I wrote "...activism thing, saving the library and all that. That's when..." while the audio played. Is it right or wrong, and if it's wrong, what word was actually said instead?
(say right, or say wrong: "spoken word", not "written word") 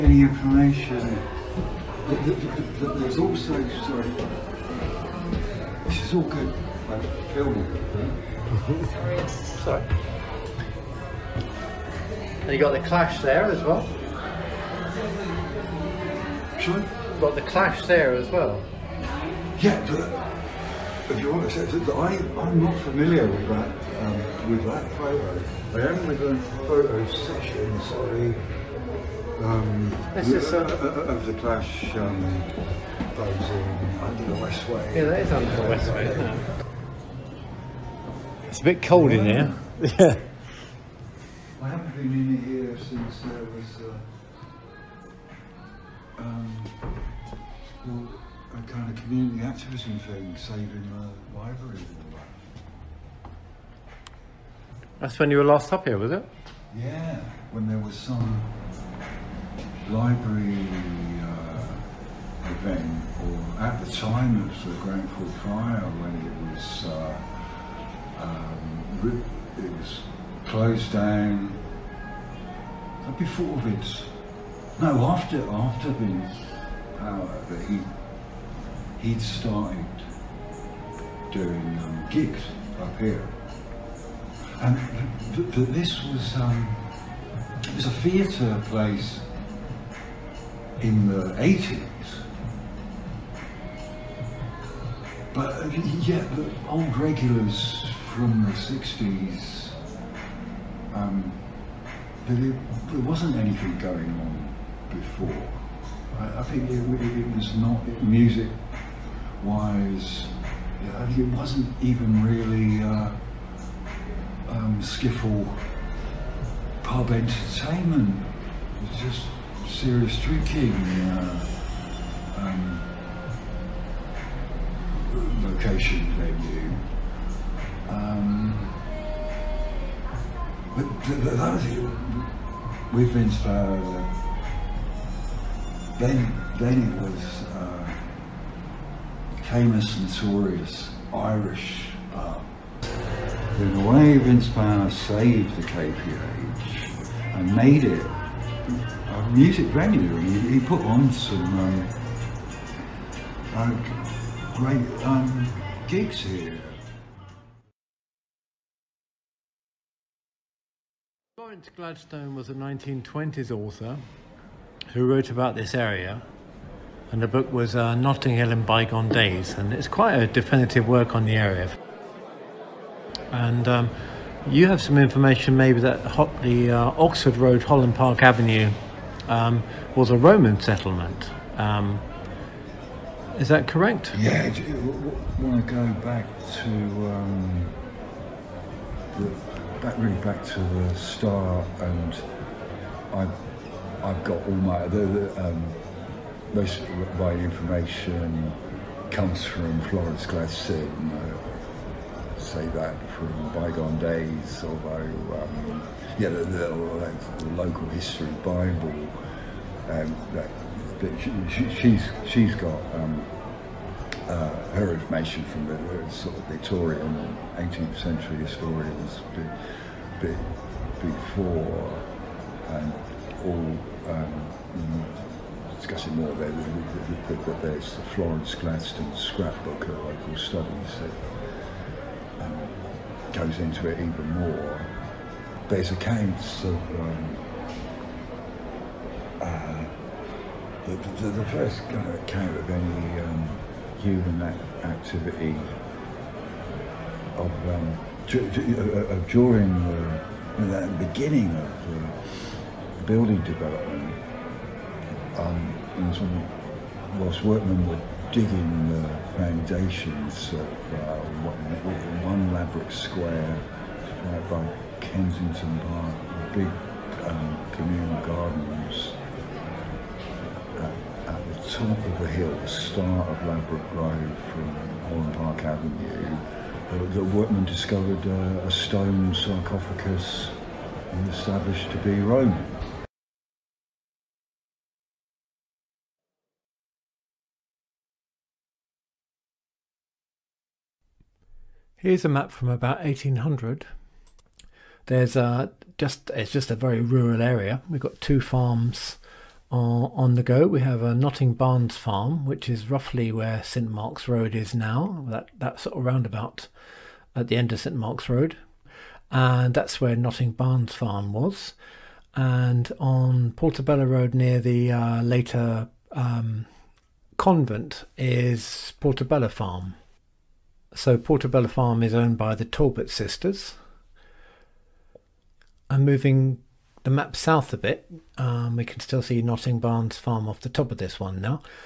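right.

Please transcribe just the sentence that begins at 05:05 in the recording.
That that sort of roundabout at the end of St Mark's Road, and that's where Notting Barnes farm was.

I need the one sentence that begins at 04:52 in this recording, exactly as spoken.
Here's a map from about 1800.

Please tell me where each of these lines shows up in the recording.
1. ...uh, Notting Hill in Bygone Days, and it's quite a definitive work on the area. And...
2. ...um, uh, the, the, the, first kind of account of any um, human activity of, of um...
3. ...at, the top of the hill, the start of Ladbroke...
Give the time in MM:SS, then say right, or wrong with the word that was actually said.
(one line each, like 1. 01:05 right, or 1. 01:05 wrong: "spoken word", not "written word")
1. 02:47 right
2. 03:56 right
3. 04:31 right.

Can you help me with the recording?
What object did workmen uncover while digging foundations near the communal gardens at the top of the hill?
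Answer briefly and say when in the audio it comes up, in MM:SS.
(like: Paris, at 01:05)
A stone sarcophagus, at 04:38.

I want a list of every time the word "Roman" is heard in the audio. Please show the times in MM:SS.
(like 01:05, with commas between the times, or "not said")
03:00, 04:42.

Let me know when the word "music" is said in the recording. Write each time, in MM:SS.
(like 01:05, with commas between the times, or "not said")
01:48, 02:29.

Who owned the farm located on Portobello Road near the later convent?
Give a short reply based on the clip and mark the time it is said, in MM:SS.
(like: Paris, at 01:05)
The Talbot sisters, at 05:22.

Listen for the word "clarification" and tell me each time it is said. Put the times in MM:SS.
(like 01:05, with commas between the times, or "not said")
not said.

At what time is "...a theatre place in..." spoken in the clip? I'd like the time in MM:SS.
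01:27.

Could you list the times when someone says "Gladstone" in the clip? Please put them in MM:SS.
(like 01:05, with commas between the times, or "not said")
02:41, 03:20, 03:48.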